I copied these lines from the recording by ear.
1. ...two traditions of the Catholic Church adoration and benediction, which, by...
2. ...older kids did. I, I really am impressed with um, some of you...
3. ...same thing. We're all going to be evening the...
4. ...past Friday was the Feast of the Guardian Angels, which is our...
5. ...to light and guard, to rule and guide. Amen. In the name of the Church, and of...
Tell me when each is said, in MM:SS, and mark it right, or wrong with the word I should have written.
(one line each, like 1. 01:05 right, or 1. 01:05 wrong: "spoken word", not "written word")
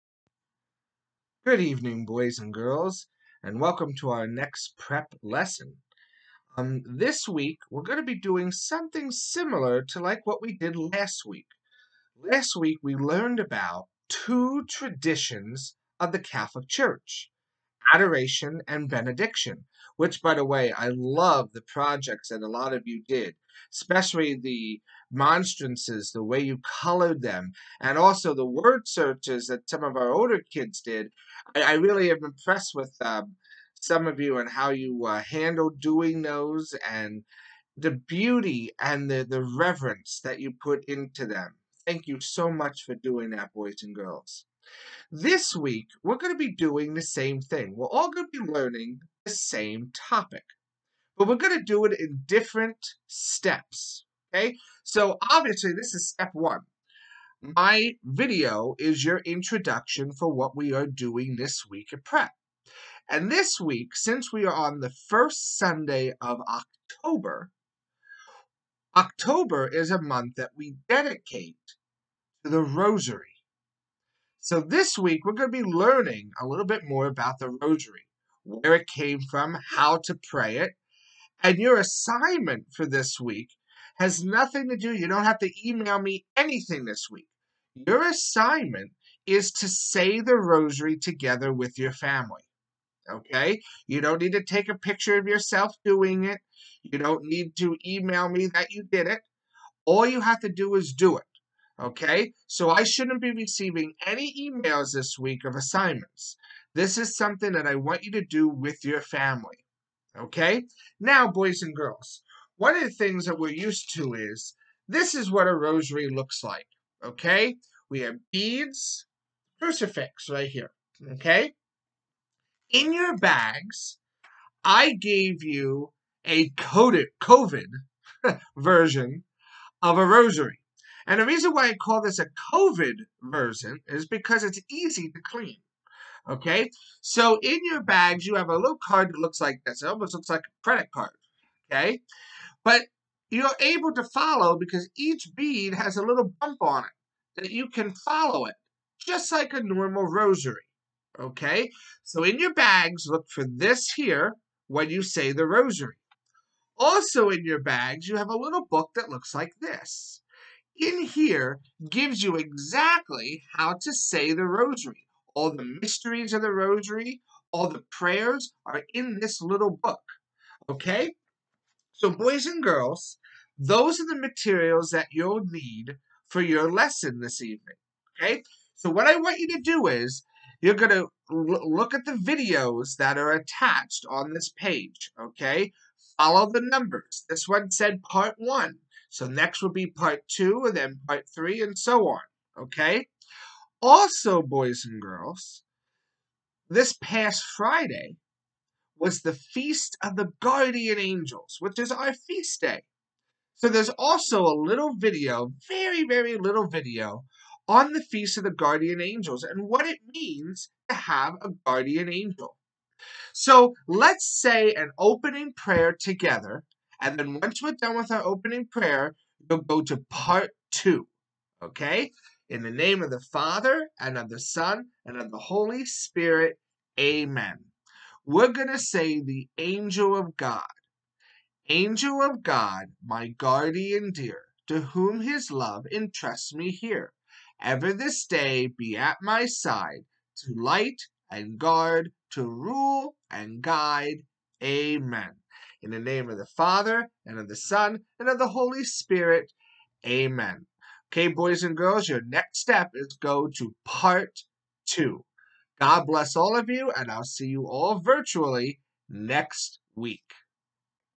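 1. 00:14 right
2. 00:30 right
3. 00:47 wrong: "learning", not "evening"
4. 03:16 right
5. 04:00 wrong: "Father", not "Church".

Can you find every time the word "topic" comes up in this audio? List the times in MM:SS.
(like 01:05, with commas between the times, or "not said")
00:49.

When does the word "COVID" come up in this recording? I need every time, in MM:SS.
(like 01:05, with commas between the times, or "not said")
02:07, 02:12.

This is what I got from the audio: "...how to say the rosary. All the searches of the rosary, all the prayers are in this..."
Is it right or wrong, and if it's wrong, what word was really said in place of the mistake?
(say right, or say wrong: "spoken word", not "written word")
wrong: "mysteries", not "searches".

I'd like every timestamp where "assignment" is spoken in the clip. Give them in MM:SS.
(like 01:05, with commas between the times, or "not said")
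01:21, 01:28, 01:45.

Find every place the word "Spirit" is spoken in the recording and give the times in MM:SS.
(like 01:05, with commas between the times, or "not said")
03:45, 04:08.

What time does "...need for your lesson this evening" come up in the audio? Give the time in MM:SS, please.
02:55.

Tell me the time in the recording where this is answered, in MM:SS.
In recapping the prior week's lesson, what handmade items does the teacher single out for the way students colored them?
00:25.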